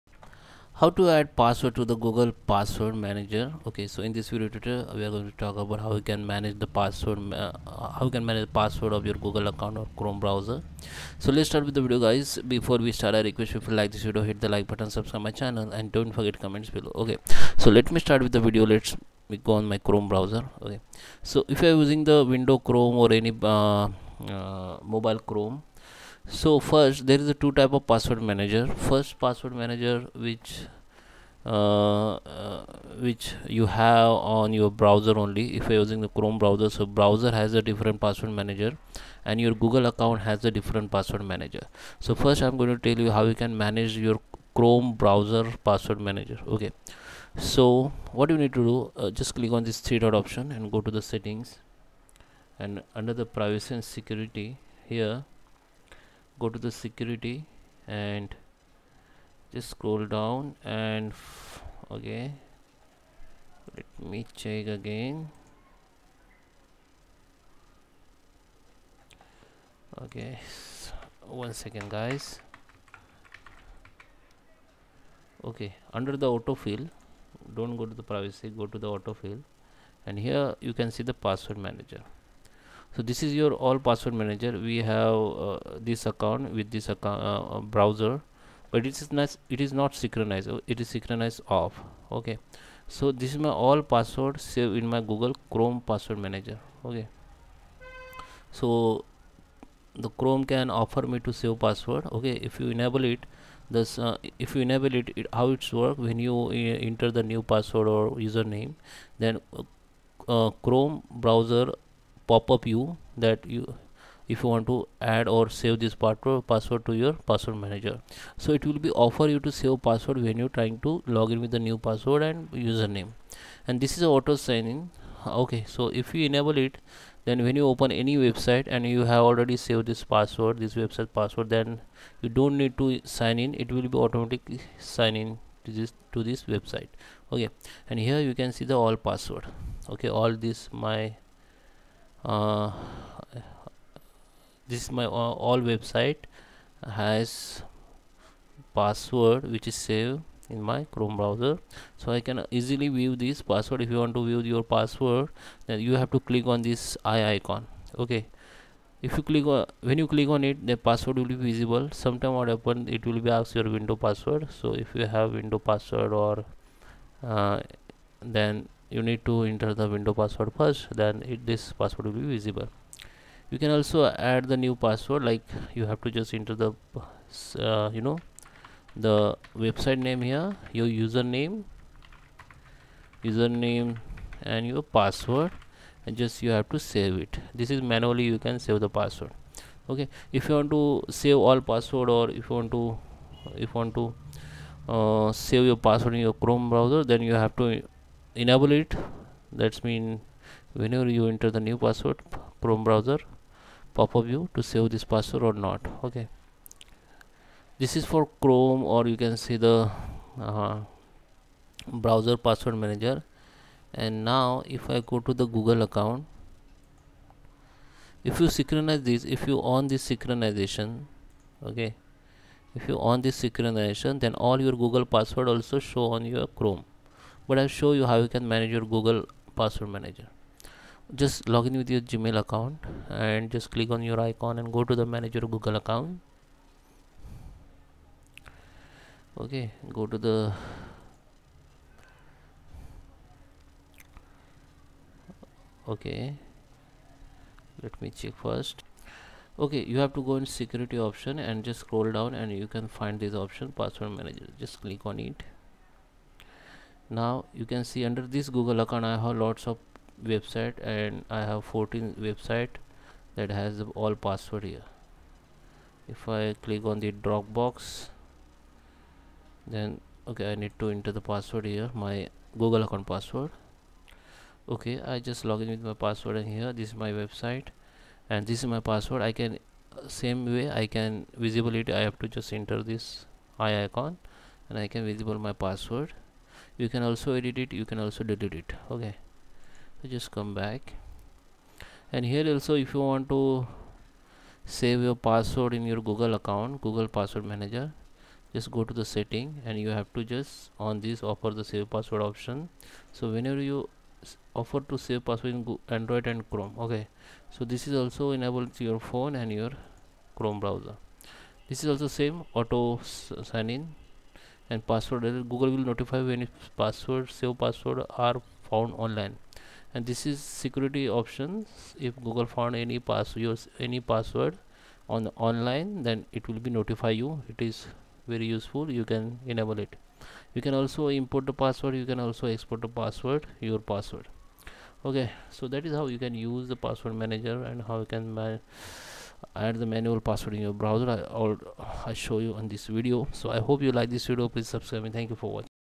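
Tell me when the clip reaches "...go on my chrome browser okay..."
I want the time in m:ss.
0:19.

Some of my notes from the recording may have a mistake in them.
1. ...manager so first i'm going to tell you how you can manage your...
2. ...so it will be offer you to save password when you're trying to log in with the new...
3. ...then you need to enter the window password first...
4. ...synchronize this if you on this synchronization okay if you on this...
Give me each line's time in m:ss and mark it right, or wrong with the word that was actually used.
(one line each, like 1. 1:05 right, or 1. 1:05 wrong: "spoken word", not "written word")
1. 0:41 right
2. 1:58 right
3. 2:48 right
4. 3:38 right.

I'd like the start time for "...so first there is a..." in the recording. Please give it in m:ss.
0:26.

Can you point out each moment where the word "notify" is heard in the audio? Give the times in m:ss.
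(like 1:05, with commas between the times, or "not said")
5:15, 5:26.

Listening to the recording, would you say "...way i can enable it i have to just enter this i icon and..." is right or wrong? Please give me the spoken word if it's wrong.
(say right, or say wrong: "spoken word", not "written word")
wrong: "visible", not "enable".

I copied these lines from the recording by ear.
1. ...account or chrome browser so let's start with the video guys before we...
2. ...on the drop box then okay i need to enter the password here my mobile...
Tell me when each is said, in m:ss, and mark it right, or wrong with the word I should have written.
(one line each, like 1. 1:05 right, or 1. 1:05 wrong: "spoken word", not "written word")
1. 0:09 right
2. 4:26 wrong: "google", not "mobile".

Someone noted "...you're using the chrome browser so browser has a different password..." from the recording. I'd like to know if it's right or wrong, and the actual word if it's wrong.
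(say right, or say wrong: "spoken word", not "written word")
right.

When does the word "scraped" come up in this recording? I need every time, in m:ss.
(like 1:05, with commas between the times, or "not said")
not said.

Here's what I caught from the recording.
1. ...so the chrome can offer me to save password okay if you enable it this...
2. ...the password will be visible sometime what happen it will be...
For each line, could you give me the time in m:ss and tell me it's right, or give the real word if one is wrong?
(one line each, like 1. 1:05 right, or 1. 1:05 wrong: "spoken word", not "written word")
1. 1:38 right
2. 2:40 right.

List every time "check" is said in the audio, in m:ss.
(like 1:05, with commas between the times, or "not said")
1:04, 4:08.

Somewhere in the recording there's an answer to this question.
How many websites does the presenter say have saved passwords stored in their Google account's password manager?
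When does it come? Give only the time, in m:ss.
4:21.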